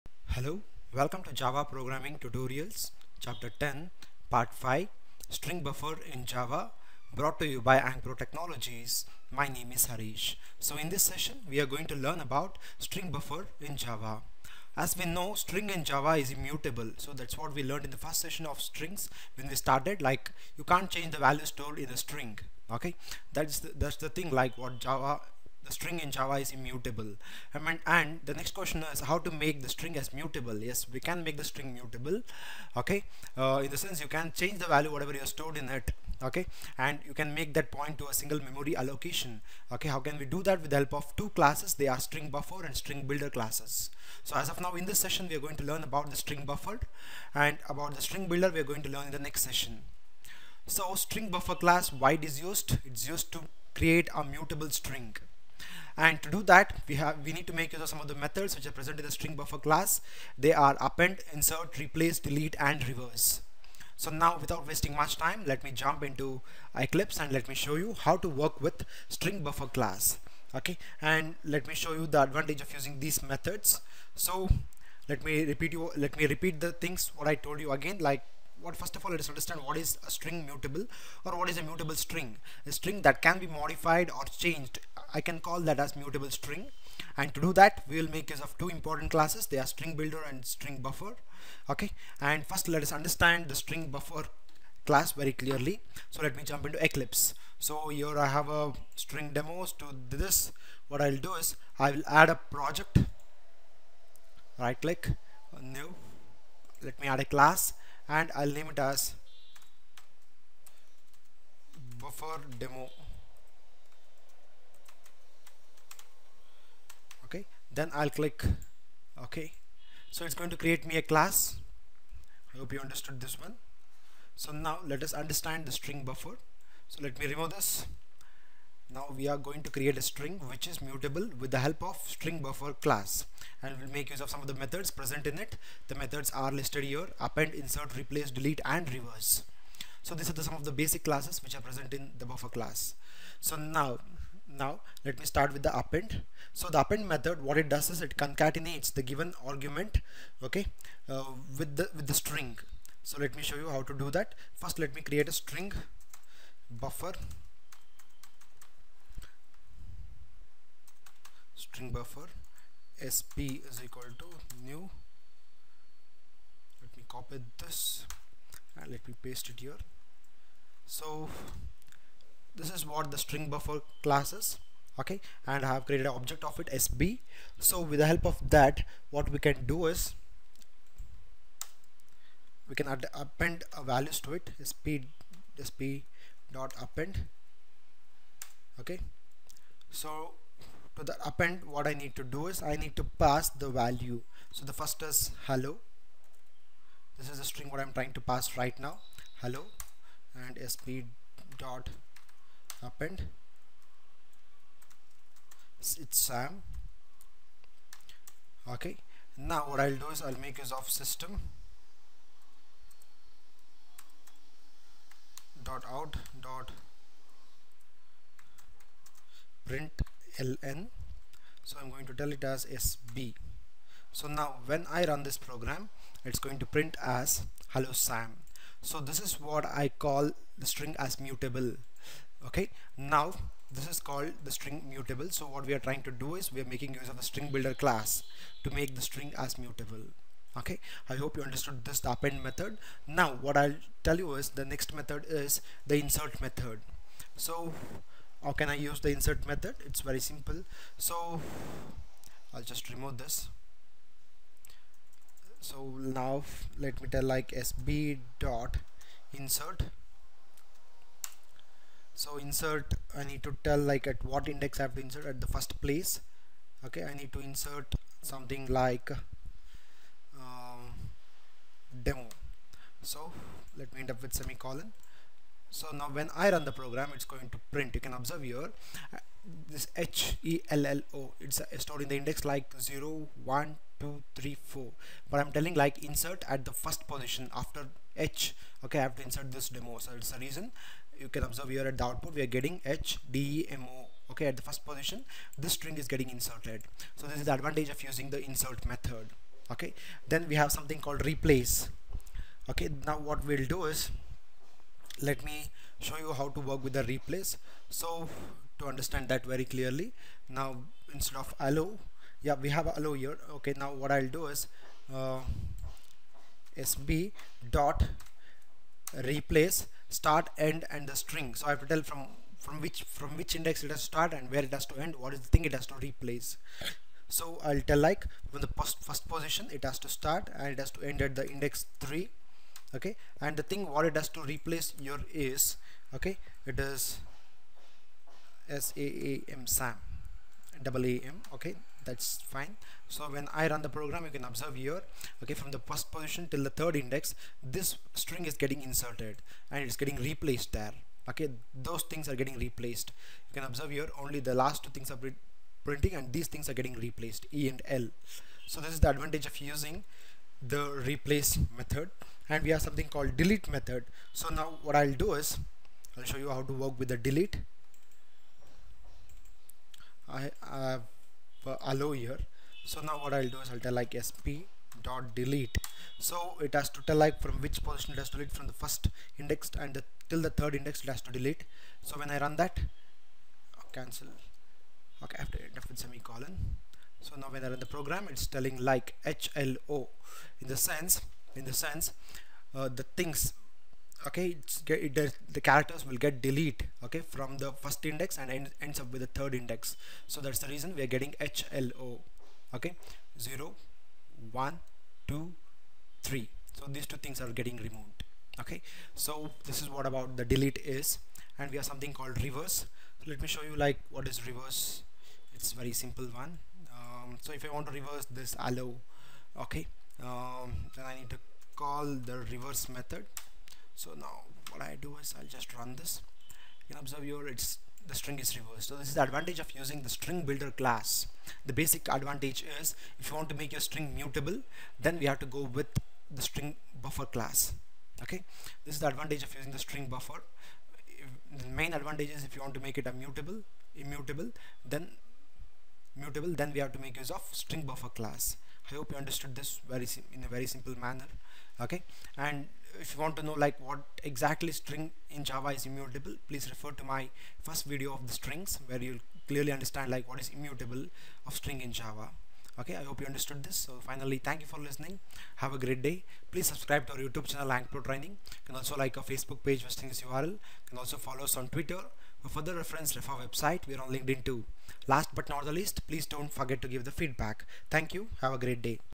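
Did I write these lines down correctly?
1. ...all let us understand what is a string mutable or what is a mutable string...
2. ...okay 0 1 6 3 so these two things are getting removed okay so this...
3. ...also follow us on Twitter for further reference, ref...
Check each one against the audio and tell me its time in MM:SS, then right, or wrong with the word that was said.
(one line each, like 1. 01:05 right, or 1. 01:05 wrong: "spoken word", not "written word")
1. 01:19 right
2. 06:42 wrong: "2", not "6"
3. 07:50 right.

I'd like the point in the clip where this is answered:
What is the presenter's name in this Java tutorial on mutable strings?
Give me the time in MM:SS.
00:09.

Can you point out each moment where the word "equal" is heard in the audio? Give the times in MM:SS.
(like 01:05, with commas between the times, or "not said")
02:43.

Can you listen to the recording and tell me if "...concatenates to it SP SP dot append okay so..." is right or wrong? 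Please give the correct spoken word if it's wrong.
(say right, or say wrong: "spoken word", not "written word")
wrong: "values", not "concatenates".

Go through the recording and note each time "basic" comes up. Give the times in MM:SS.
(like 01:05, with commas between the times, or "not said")
02:20, 07:11.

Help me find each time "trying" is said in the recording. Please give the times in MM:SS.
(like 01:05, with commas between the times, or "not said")
03:17, 03:55.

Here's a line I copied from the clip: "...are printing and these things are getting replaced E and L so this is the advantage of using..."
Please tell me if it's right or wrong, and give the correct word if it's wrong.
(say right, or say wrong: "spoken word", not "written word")
right.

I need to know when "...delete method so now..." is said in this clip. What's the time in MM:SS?
06:03.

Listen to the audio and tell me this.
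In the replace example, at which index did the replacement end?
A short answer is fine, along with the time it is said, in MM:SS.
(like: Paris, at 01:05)
3, at 05:31.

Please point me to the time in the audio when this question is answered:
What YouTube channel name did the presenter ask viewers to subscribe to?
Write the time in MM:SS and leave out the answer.
07:47.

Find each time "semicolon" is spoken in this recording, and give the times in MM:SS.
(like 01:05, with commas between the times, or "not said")
04:34, 06:25.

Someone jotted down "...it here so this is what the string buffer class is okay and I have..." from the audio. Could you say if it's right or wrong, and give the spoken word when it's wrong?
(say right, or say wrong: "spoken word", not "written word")
right.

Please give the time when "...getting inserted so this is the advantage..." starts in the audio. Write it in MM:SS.
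04:56.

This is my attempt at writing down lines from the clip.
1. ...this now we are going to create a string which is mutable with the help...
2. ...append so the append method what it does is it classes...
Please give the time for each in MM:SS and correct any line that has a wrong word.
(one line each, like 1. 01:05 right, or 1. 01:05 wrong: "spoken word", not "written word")
1. 02:07 right
2. 02:25 wrong: "concatenates", not "classes".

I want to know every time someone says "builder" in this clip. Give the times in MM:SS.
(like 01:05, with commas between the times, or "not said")
00:43, 00:48, 01:29, 03:57, 07:10.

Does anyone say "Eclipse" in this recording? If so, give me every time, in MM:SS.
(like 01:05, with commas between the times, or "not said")
01:06, 01:36.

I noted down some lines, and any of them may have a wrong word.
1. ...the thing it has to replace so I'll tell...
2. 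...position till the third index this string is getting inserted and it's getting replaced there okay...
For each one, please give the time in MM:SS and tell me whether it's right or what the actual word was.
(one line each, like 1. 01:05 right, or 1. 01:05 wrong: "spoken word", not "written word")
1. 05:25 right
2. 05:46 right.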